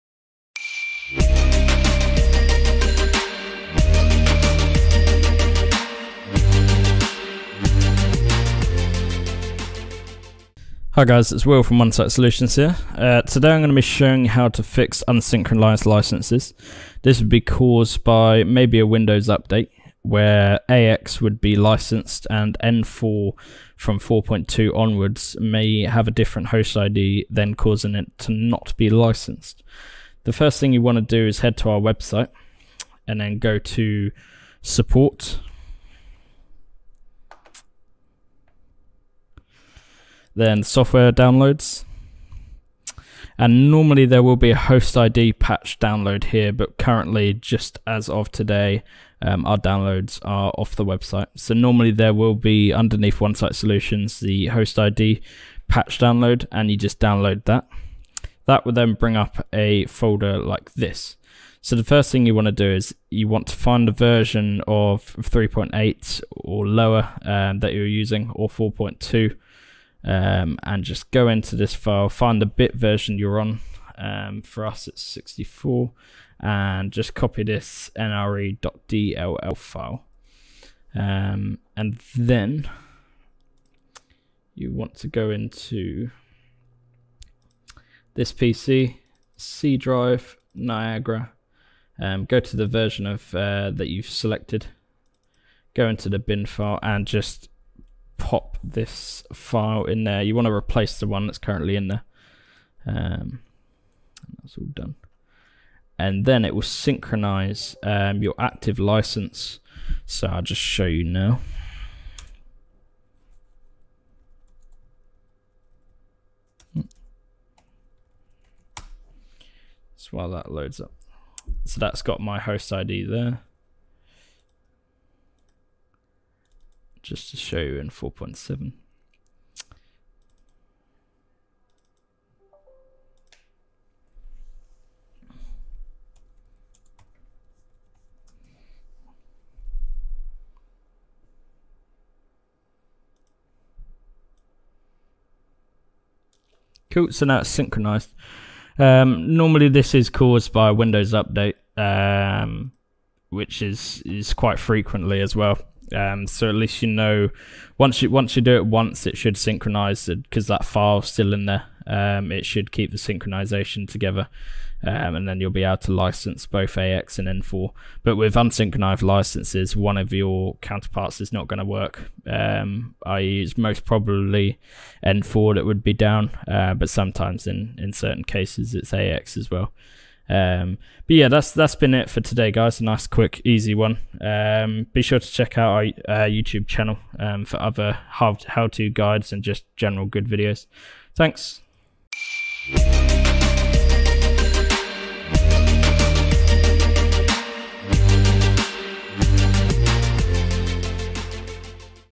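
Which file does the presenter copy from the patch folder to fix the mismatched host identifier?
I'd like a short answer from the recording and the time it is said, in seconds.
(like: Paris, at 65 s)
nre.dll, at 77 s.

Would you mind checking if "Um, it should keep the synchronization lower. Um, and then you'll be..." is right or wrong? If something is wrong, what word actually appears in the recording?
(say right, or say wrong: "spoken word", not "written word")
wrong: "together", not "lower".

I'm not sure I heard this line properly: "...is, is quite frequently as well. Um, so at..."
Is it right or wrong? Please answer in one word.
right.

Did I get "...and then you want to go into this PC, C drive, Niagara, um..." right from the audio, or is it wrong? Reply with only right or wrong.
right.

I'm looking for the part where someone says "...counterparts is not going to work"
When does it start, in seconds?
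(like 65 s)
170 s.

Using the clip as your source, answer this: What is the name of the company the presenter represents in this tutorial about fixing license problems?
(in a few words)
Onesight Site Solutions.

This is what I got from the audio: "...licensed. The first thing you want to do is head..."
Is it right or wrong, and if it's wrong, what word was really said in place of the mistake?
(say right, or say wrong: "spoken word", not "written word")
right.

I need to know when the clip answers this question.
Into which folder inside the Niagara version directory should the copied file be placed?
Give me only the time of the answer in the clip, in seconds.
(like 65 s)
96 s.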